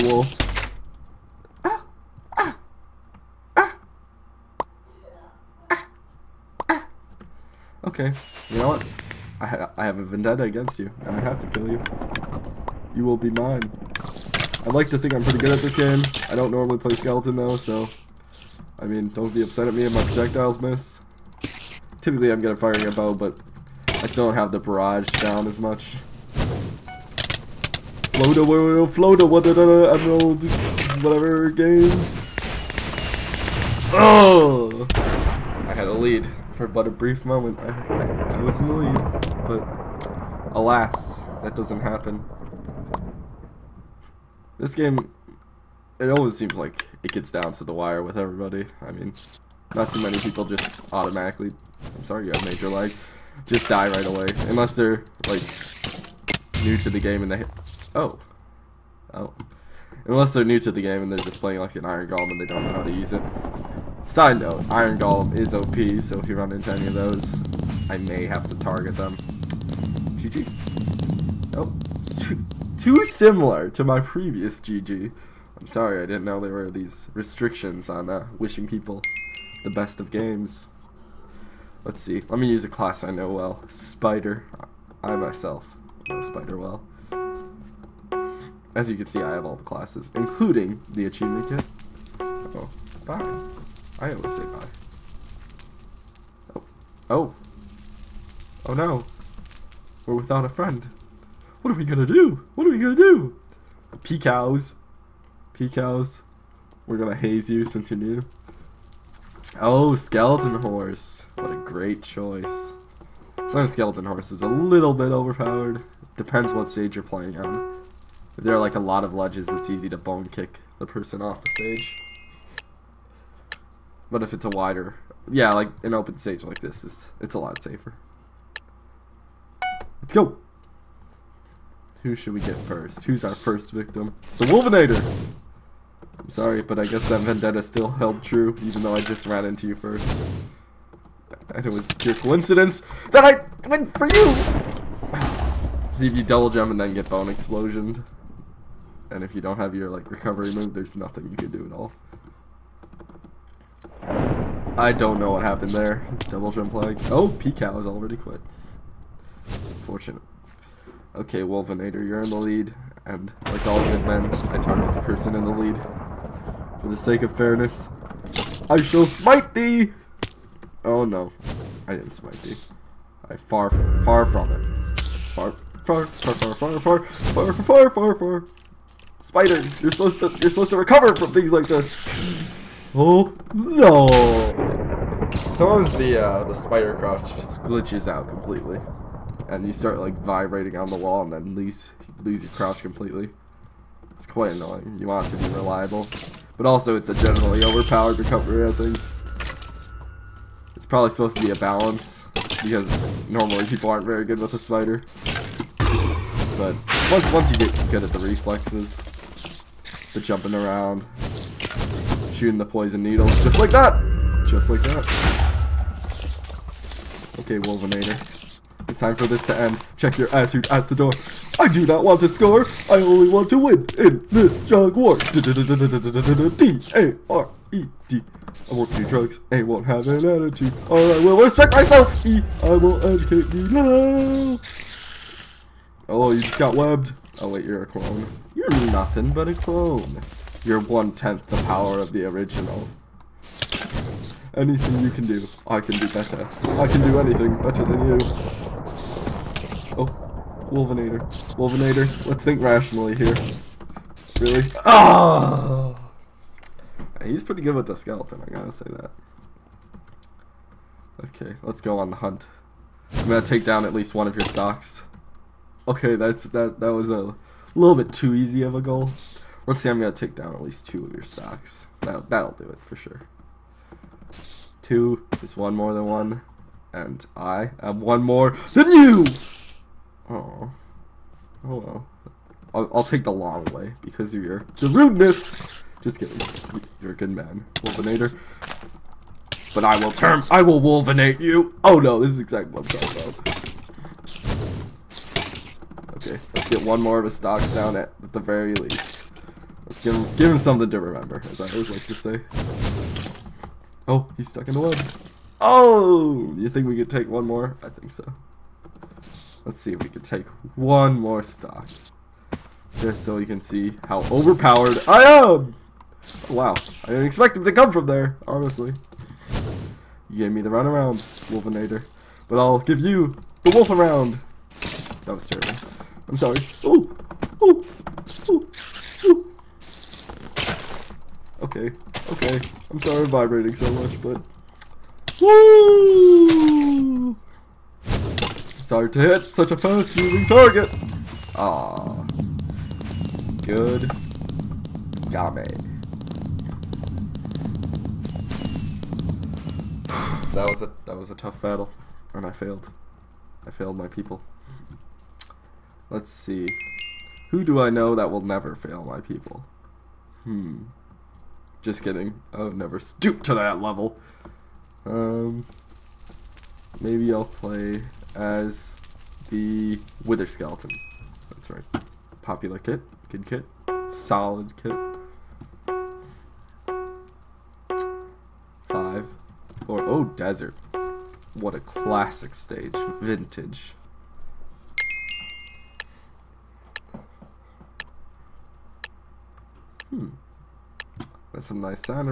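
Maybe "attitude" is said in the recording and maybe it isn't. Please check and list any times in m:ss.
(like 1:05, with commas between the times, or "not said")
3:40, 3:50.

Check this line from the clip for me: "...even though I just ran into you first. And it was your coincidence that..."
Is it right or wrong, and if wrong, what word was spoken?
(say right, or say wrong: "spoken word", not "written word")
right.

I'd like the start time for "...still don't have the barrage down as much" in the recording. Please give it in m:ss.
0:24.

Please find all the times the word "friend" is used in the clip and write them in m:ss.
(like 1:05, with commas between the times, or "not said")
1:40.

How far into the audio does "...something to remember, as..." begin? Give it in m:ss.
5:00.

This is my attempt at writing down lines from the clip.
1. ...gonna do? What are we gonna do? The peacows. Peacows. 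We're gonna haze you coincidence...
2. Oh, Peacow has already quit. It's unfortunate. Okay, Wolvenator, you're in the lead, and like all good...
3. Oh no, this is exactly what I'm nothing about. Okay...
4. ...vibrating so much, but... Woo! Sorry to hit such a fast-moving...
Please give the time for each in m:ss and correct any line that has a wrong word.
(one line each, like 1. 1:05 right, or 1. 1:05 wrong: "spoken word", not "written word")
1. 1:41 wrong: "since", not "coincidence"
2. 2:37 right
3. 4:51 wrong: "talking", not "nothing"
4. 5:33 right.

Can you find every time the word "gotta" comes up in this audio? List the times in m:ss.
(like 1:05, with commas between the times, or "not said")
4:18.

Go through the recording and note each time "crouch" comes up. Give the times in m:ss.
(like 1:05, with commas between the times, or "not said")
3:06, 3:12.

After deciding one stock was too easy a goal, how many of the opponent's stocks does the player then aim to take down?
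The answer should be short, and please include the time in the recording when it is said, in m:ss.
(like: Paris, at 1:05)
2, at 4:30.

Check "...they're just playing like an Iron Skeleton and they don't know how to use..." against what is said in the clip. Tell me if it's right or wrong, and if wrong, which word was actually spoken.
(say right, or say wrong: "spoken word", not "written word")
wrong: "Golem", not "Skeleton".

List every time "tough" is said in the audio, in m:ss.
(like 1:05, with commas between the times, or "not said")
5:51.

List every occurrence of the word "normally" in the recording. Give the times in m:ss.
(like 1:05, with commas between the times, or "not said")
0:16, 3:23.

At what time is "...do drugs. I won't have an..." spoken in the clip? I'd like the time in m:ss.
3:48.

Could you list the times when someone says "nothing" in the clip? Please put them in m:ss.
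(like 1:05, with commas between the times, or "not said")
2:30, 3:58.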